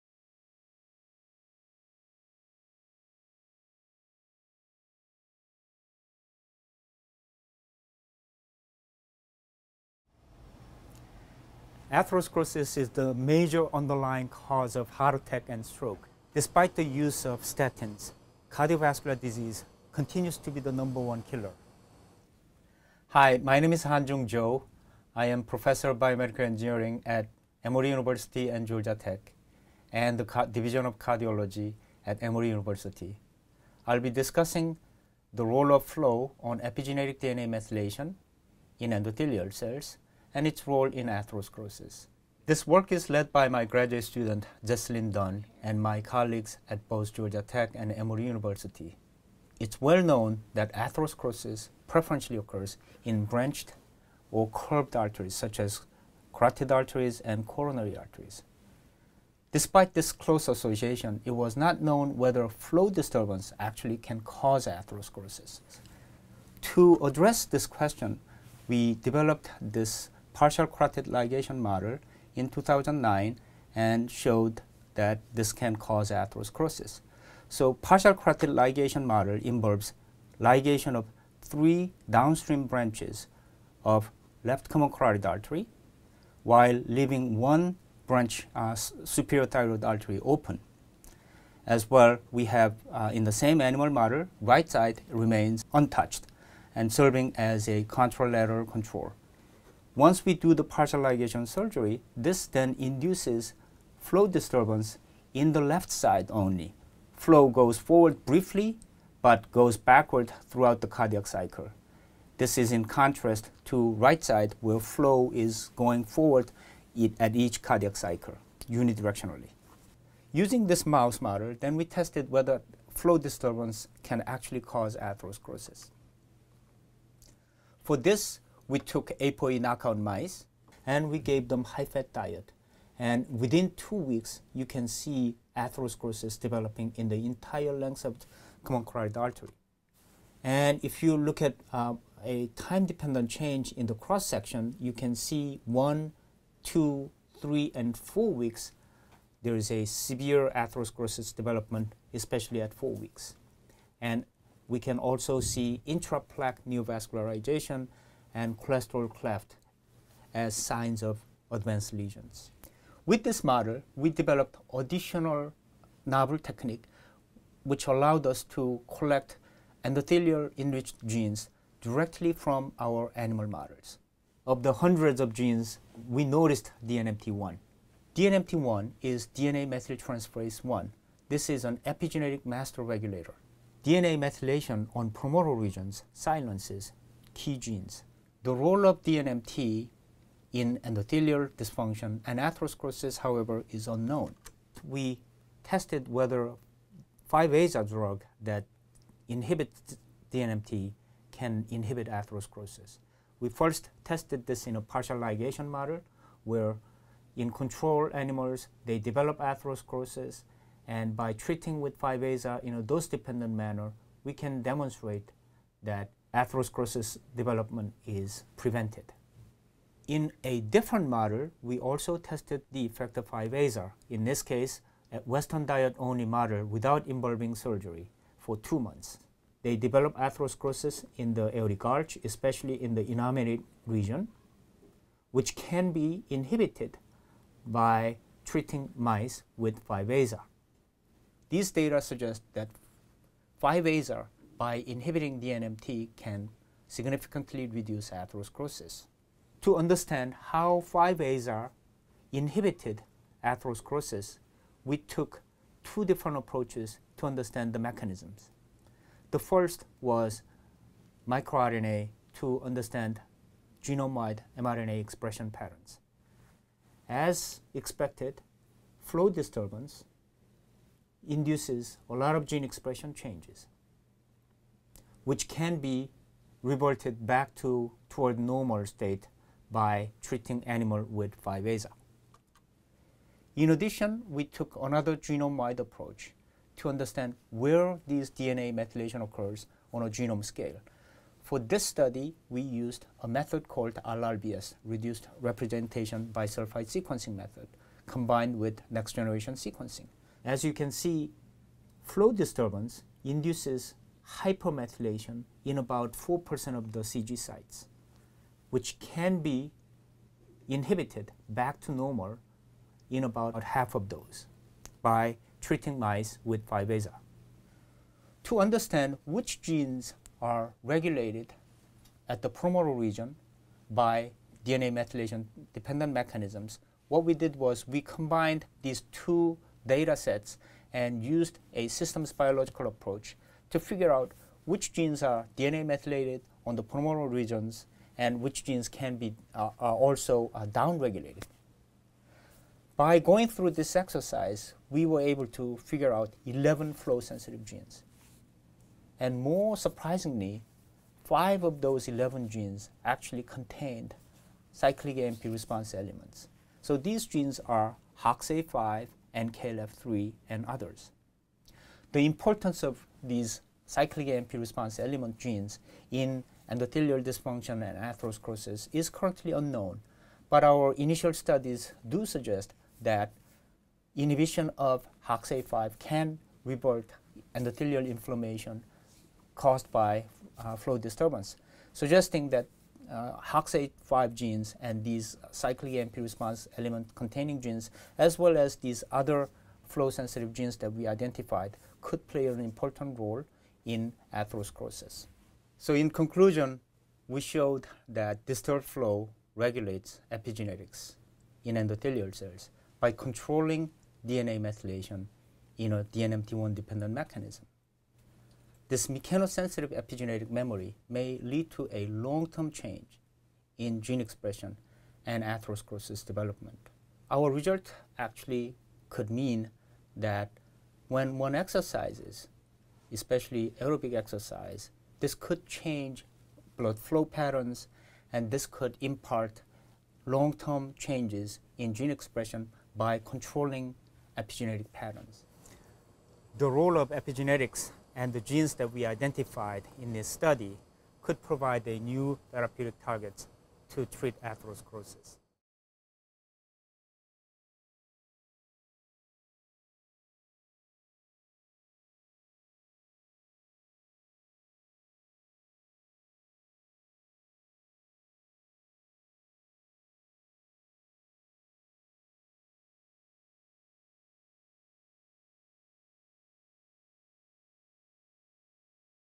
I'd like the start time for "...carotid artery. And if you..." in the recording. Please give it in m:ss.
2:18.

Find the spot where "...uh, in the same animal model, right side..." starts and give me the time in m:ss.
1:32.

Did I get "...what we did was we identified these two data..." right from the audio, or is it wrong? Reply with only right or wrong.
wrong.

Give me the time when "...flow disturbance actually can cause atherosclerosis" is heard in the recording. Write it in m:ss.
1:02.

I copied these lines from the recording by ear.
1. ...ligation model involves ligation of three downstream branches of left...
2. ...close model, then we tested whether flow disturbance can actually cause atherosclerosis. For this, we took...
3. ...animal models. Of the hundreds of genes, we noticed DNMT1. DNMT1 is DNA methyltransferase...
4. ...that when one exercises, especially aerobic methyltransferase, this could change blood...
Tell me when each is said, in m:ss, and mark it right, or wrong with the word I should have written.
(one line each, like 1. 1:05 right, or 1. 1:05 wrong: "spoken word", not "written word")
1. 1:18 right
2. 2:00 wrong: "mouse", not "close"
3. 2:53 right
4. 7:00 wrong: "exercise", not "methyltransferase".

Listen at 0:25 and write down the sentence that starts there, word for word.
I am professor of biomedical engineering at Emory University and Georgia Tech and the Division of Cardiology at Emory University.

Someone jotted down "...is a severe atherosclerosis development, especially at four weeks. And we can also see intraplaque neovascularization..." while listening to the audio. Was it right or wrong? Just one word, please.
right.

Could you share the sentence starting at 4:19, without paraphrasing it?
The first was microarray to understand genome-wide mRNA expression patterns.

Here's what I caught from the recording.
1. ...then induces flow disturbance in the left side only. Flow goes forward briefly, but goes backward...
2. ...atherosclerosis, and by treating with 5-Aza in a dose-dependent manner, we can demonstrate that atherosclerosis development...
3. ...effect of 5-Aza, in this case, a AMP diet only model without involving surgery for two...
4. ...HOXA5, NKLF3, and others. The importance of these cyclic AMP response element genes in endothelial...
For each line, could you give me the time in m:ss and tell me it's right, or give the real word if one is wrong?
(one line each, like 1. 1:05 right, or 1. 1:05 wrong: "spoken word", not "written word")
1. 1:42 right
2. 3:29 right
3. 3:42 wrong: "Western", not "AMP"
4. 5:58 right.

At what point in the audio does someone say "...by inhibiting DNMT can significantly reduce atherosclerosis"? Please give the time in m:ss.
4:04.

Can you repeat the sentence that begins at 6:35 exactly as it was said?
So in conclusion, we showed that disturbed flow regulates epigenetics in endothelial cells by controlling DNA methylation in a DNMT1-dependent mechanism.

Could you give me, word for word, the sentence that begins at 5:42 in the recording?
By going through this exercise, we were able to figure out 11 flow-sensitive genes.